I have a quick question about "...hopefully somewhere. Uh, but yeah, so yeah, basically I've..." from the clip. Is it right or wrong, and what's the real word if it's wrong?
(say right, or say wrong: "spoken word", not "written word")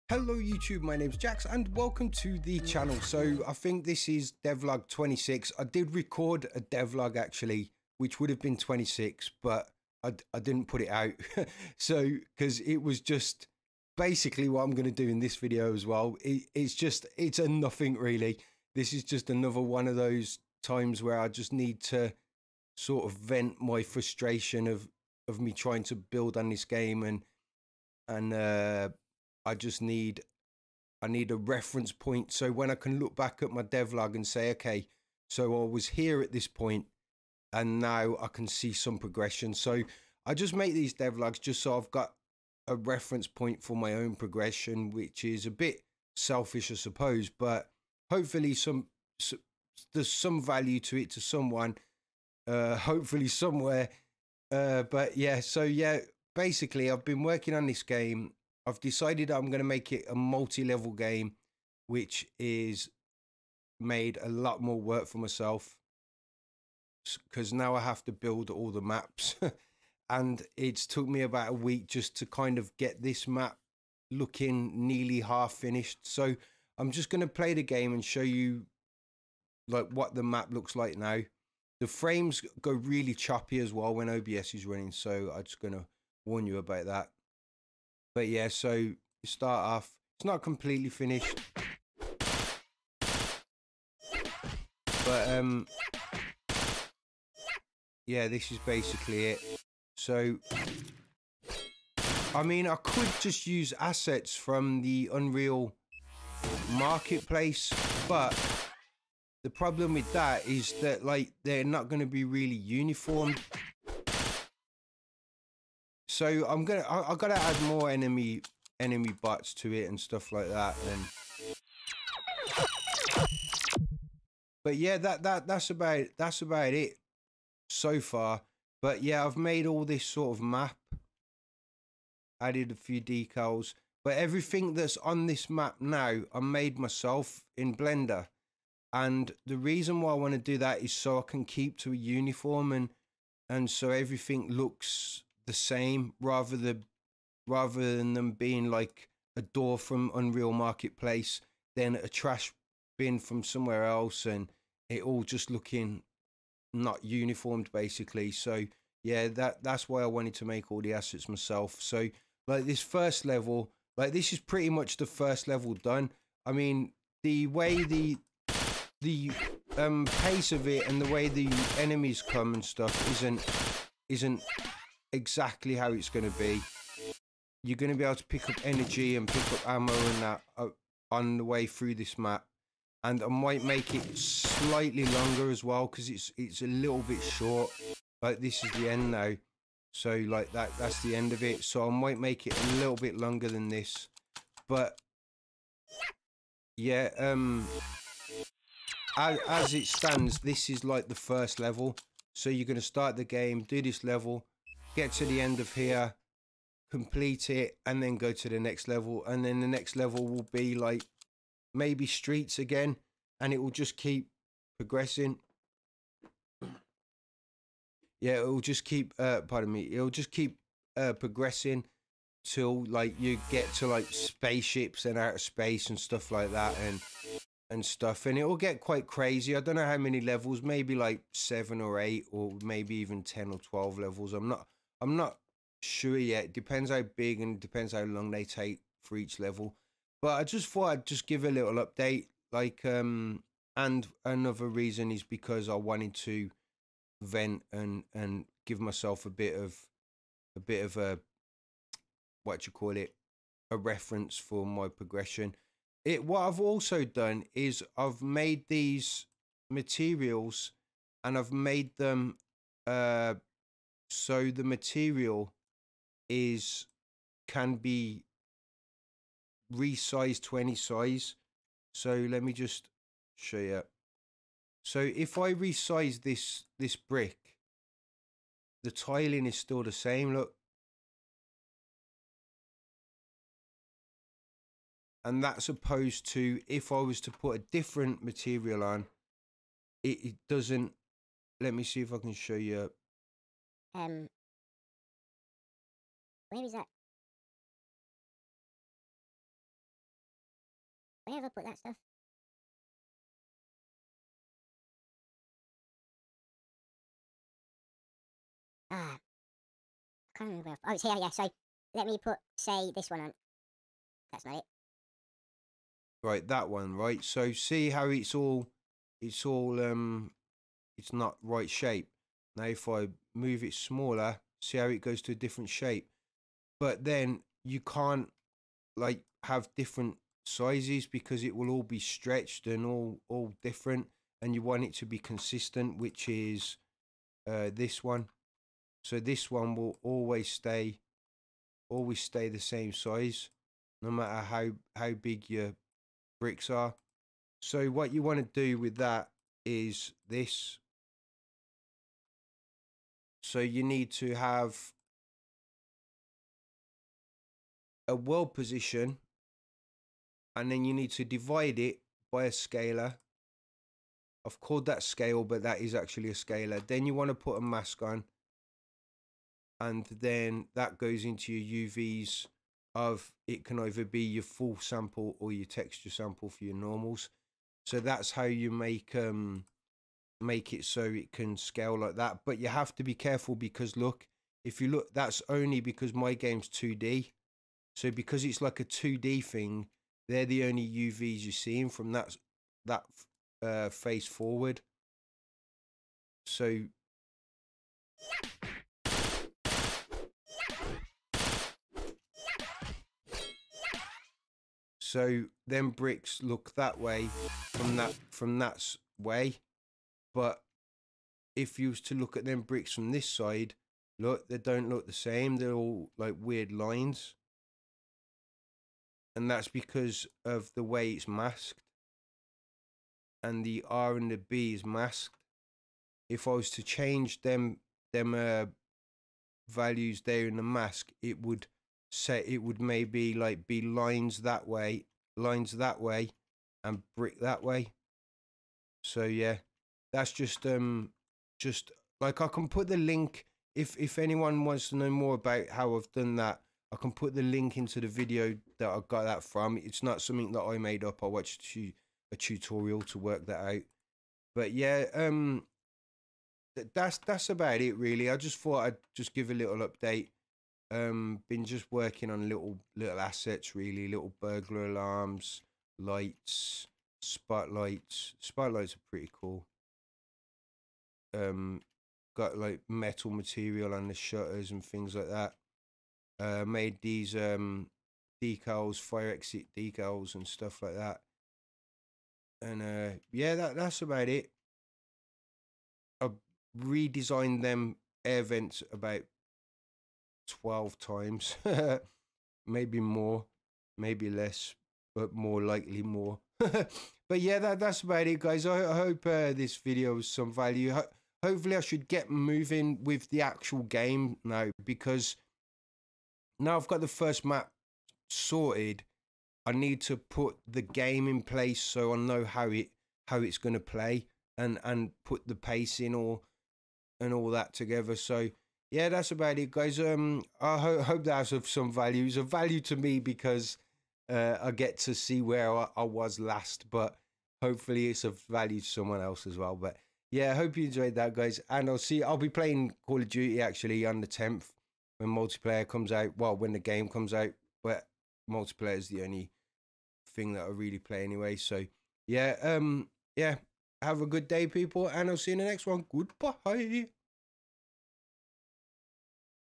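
right.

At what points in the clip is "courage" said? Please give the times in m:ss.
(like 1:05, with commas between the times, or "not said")
not said.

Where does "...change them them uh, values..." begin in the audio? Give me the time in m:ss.
7:06.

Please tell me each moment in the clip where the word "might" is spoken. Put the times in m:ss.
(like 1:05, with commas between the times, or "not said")
3:03, 3:11.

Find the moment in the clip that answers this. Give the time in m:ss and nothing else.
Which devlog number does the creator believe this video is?
0:04.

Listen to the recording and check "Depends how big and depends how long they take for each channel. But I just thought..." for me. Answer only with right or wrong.
wrong.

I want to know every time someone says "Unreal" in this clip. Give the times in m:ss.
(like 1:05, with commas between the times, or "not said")
1:45, 2:30.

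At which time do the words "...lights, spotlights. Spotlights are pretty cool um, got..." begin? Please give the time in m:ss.
7:45.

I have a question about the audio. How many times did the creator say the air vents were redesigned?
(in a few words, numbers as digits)
12.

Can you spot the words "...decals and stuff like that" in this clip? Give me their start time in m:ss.
7:59.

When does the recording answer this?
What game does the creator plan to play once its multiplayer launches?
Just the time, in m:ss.
8:53.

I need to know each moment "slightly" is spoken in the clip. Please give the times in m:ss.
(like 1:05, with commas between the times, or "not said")
3:04.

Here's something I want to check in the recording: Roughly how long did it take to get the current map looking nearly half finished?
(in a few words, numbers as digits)
About a week.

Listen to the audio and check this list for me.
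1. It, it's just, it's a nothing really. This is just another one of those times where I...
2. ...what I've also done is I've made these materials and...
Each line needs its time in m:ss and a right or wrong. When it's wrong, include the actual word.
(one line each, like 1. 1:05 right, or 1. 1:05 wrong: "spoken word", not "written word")
1. 0:16 right
2. 4:16 right.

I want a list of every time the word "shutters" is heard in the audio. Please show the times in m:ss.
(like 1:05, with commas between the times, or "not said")
7:54.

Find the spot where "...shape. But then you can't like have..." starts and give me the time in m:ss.
5:25.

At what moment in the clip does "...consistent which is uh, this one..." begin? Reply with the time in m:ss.
5:35.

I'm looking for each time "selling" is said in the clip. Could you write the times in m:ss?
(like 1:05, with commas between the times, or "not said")
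not said.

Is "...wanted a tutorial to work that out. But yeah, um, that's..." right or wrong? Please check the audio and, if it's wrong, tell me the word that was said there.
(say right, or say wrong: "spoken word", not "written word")
wrong: "watched", not "wanted".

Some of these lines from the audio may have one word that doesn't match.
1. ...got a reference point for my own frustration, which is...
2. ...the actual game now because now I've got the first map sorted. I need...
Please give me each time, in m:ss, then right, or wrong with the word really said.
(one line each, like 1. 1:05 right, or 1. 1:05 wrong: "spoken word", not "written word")
1. 0:41 wrong: "progression", not "frustration"
2. 8:23 right.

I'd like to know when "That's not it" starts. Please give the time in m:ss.
5:14.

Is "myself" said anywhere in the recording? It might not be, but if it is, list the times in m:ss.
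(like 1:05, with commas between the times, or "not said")
1:05, 2:16, 2:41, 4:08.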